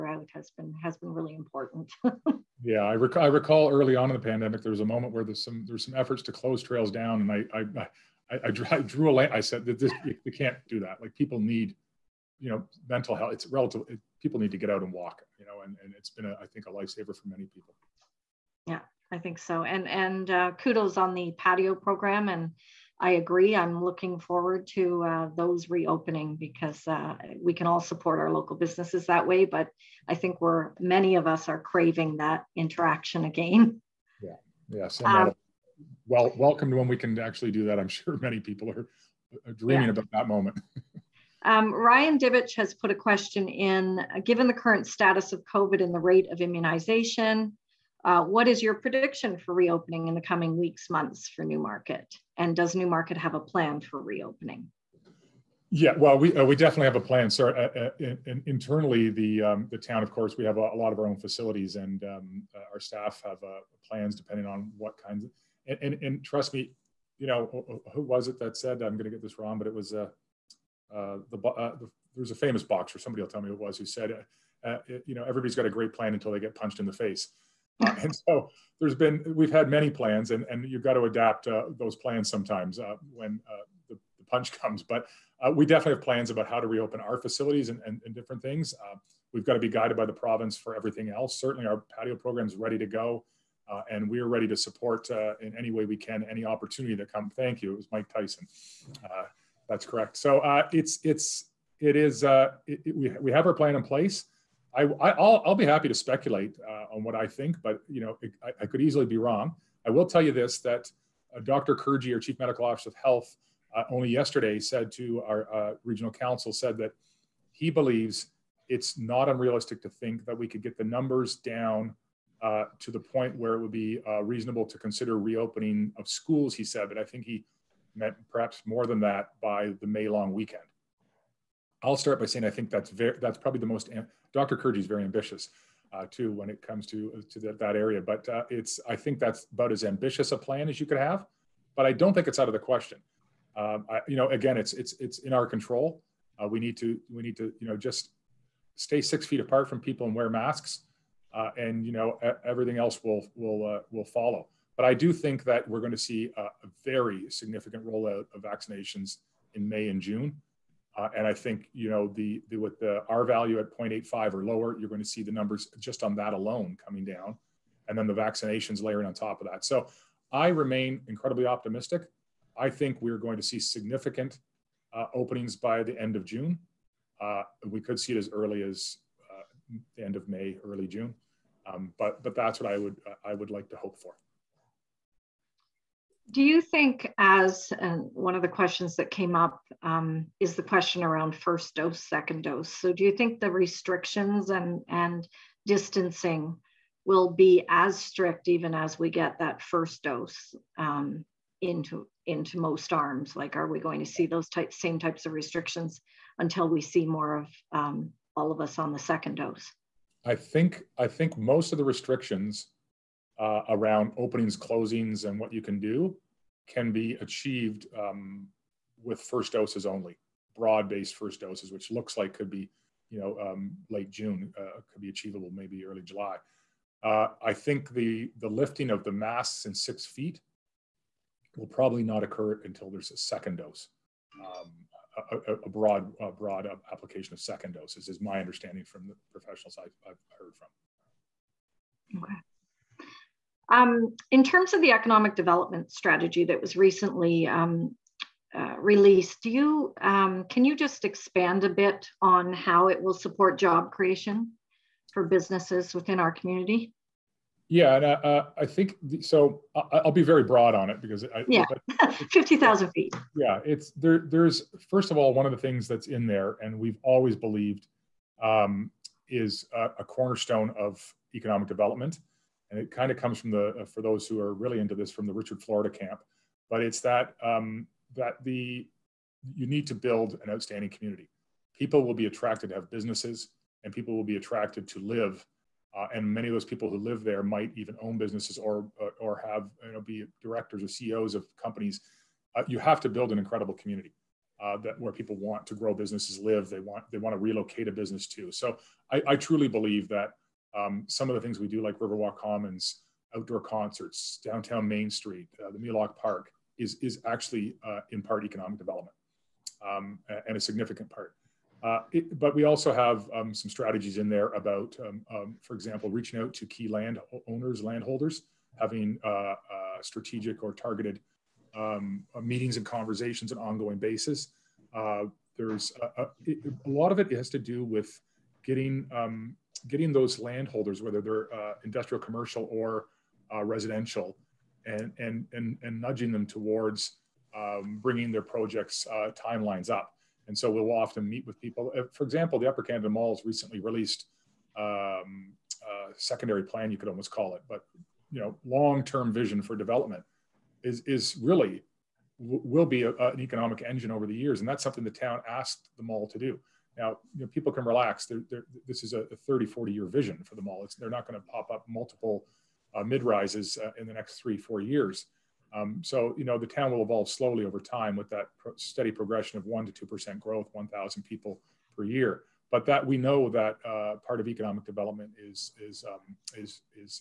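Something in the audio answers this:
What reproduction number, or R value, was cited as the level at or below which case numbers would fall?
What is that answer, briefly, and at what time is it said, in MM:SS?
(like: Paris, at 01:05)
0.85, at 02:43.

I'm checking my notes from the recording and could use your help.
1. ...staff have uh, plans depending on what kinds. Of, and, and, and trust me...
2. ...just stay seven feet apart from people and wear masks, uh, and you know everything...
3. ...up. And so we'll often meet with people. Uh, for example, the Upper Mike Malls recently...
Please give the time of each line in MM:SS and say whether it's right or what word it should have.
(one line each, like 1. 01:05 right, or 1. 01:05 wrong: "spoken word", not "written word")
1. 01:02 right
2. 02:27 wrong: "six", not "seven"
3. 05:39 wrong: "Canada", not "Mike".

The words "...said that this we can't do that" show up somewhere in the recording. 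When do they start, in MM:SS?
00:09.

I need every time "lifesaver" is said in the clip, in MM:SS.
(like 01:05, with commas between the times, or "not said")
00:16.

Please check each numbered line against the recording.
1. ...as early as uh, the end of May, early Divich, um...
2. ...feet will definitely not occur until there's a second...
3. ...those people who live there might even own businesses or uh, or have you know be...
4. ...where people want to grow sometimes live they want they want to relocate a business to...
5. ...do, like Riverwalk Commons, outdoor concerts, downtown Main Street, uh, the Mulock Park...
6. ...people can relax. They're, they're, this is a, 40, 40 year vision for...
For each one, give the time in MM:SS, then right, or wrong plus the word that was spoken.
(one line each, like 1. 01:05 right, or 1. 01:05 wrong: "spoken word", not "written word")
1. 02:58 wrong: "June", not "Divich"
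2. 03:50 wrong: "probably", not "definitely"
3. 04:46 right
4. 04:54 wrong: "businesses", not "sometimes"
5. 05:01 right
6. 05:57 wrong: "30", not "40".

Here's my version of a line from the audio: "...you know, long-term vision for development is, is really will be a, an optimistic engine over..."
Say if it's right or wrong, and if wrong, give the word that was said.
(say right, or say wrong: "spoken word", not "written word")
wrong: "economic", not "optimistic".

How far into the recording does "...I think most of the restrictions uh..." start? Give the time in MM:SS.
03:30.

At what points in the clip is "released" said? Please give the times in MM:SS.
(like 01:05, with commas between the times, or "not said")
04:08, 05:43.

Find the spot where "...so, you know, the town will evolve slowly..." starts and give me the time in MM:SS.
06:06.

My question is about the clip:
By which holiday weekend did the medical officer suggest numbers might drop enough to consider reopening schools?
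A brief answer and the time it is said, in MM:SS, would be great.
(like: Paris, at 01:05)
May long weekend, at 02:09.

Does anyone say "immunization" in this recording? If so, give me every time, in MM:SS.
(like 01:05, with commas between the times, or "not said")
00:46.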